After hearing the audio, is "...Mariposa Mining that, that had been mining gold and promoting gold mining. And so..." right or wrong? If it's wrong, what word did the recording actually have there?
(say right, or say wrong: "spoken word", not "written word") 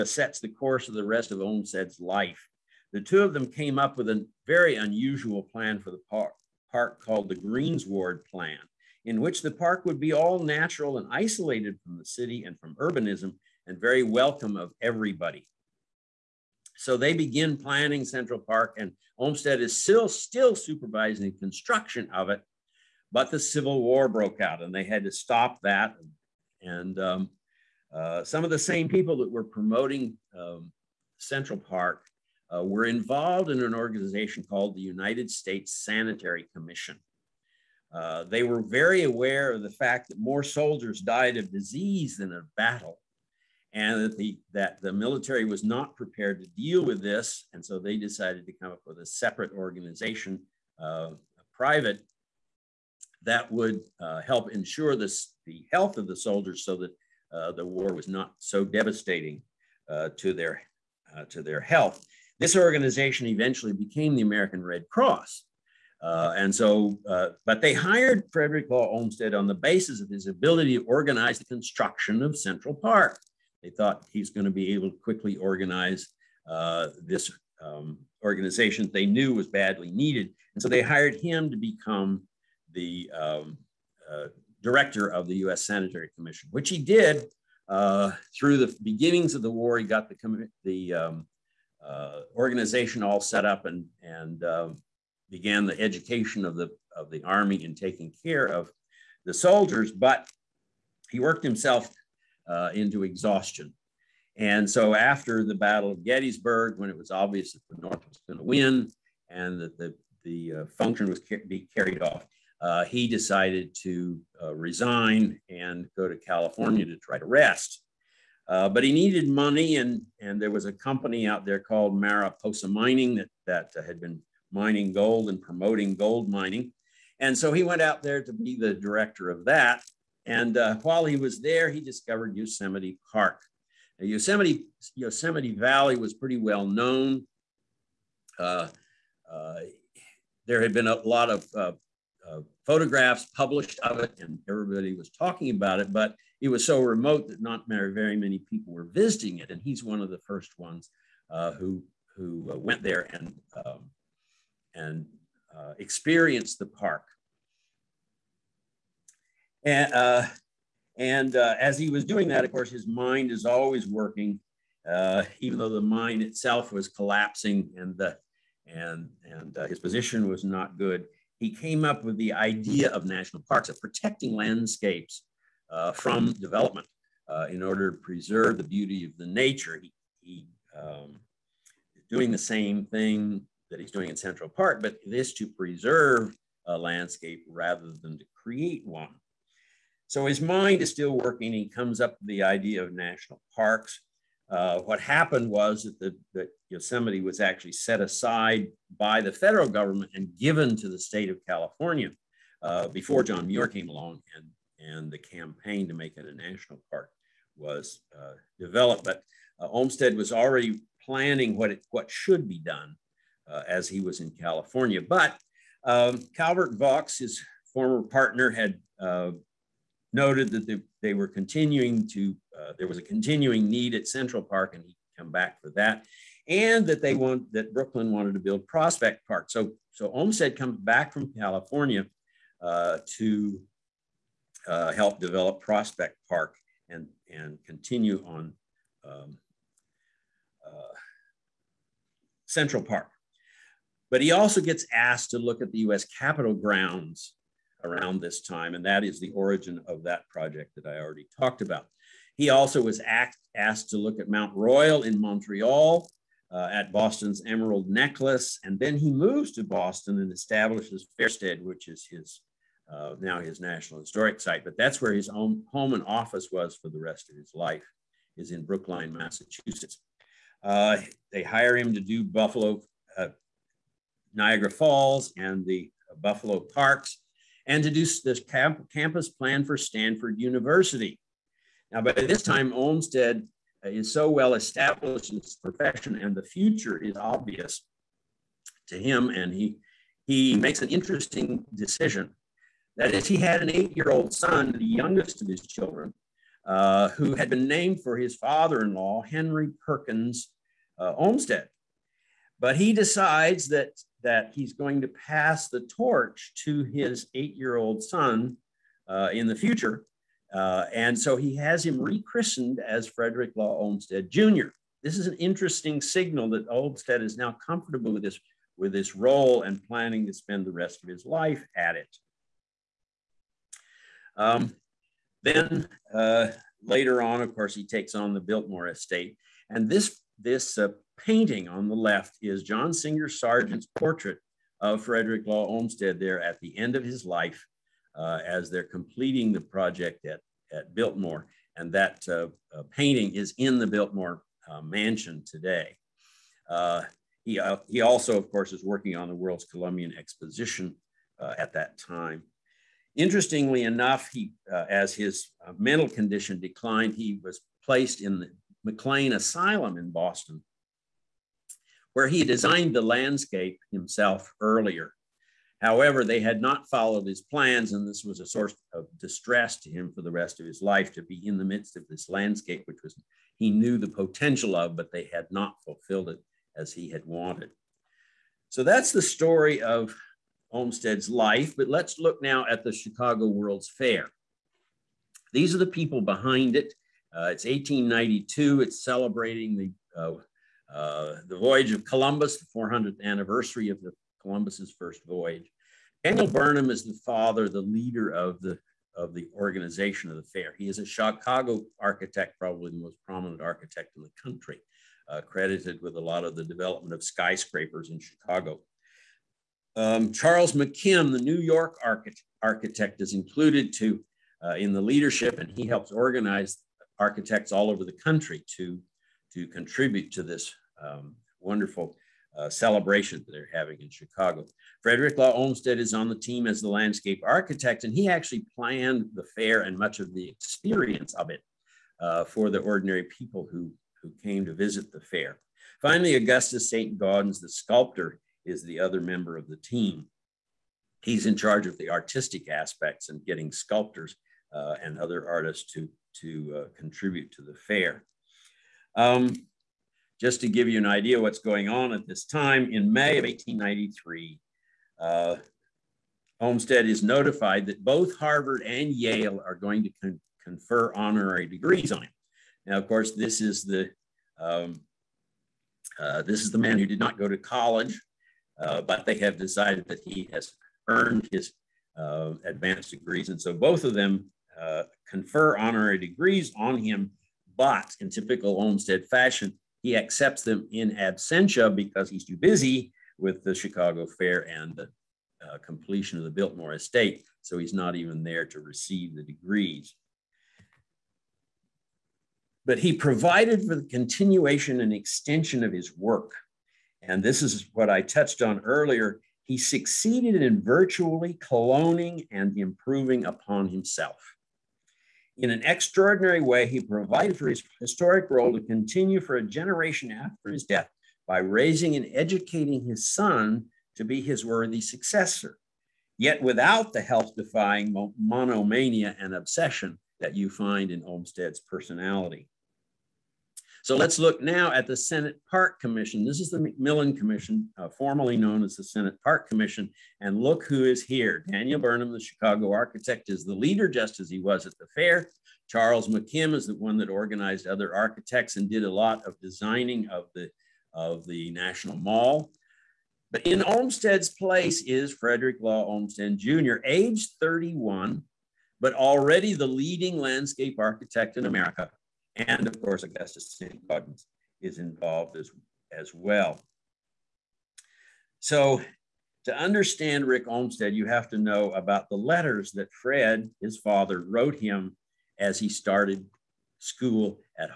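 right.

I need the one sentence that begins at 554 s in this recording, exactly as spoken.
Gaudens is involved as, as well.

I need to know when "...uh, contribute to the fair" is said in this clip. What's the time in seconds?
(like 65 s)
446 s.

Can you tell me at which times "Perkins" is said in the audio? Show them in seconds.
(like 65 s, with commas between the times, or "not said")
299 s.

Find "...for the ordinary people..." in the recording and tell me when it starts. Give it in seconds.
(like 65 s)
432 s.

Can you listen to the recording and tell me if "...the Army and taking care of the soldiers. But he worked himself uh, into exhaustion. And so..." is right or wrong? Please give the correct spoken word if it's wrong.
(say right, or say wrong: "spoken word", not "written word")
right.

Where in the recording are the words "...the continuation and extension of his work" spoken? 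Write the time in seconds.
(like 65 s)
493 s.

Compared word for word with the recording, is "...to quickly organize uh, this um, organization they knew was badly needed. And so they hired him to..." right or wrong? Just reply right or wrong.
right.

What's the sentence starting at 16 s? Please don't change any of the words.
So they begin planning Central Park, and Olmsted is still, still supervising construction of it.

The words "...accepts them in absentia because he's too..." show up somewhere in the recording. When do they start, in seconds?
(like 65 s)
480 s.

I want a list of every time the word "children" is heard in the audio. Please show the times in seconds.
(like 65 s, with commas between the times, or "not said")
295 s.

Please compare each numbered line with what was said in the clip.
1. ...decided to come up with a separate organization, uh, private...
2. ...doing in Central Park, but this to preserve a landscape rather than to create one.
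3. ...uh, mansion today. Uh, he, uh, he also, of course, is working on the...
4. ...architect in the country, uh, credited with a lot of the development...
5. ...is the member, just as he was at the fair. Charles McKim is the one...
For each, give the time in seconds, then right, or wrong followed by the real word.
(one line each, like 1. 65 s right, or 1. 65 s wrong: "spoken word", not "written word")
1. 47 s right
2. 183 s right
3. 344 s right
4. 403 s right
5. 533 s wrong: "leader", not "member".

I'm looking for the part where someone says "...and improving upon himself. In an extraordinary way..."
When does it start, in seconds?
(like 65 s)
502 s.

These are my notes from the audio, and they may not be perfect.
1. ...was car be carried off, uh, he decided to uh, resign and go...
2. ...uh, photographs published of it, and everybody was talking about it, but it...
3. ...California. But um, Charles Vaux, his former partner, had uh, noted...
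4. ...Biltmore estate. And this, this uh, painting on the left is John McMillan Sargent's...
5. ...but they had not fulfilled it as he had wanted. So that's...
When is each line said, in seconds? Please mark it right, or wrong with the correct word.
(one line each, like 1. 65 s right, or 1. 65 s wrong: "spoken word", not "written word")
1. 111 s right
2. 142 s right
3. 214 s wrong: "Calvert", not "Charles"
4. 328 s wrong: "Singer", not "McMillan"
5. 374 s right.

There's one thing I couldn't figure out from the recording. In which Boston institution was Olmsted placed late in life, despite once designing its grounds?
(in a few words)
McLean Asylum.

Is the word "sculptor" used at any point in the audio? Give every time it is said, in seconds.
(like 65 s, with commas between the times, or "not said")
437 s, 443 s.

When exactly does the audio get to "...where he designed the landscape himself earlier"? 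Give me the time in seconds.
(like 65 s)
362 s.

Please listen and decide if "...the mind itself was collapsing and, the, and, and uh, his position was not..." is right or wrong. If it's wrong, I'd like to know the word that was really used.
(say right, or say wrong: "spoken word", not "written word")
right.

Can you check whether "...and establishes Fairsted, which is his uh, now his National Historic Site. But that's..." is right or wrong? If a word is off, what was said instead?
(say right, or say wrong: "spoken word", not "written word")
right.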